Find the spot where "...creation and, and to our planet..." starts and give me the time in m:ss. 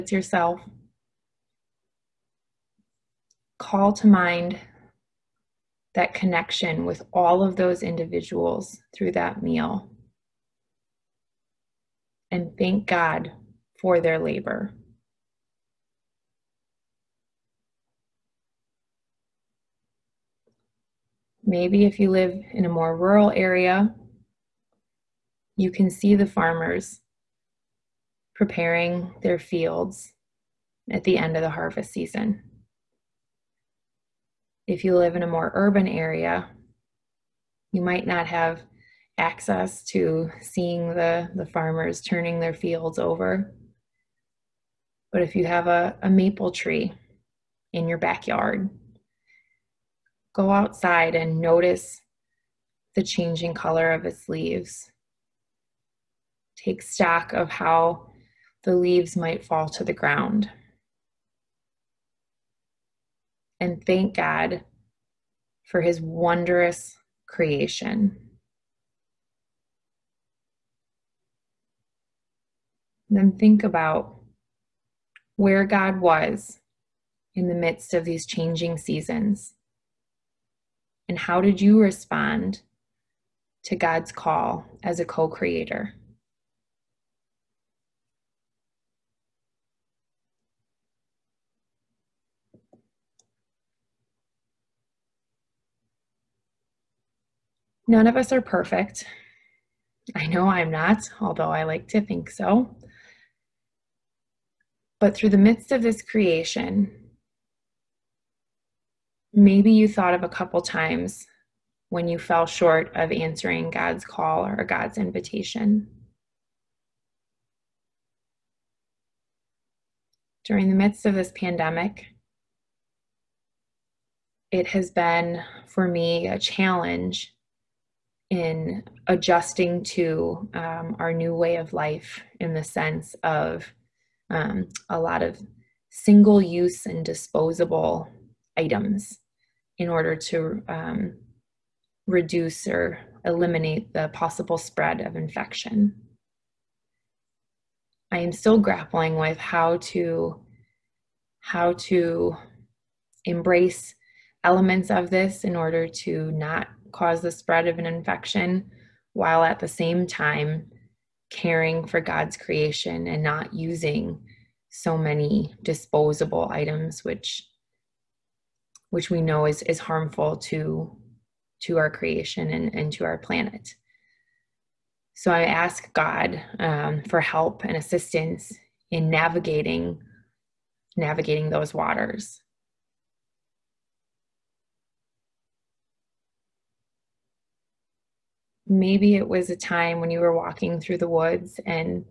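2:51.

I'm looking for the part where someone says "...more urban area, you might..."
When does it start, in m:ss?
0:35.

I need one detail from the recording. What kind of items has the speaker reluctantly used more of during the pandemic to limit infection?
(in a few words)
Single use and disposable items.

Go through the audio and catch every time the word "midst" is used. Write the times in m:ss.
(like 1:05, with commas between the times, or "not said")
1:17, 1:45, 2:00.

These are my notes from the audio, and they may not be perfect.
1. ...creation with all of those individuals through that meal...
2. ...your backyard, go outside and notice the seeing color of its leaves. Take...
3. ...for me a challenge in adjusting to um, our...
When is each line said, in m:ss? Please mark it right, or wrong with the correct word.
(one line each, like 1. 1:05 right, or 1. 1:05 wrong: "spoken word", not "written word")
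1. 0:06 wrong: "connection", not "creation"
2. 0:47 wrong: "changing", not "seeing"
3. 2:05 right.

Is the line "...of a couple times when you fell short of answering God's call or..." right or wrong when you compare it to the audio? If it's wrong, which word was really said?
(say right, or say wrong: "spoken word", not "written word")
right.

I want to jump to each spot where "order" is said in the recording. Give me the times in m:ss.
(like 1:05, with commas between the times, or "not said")
2:19, 2:35.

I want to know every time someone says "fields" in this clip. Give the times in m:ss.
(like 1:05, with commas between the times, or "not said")
0:29, 0:42.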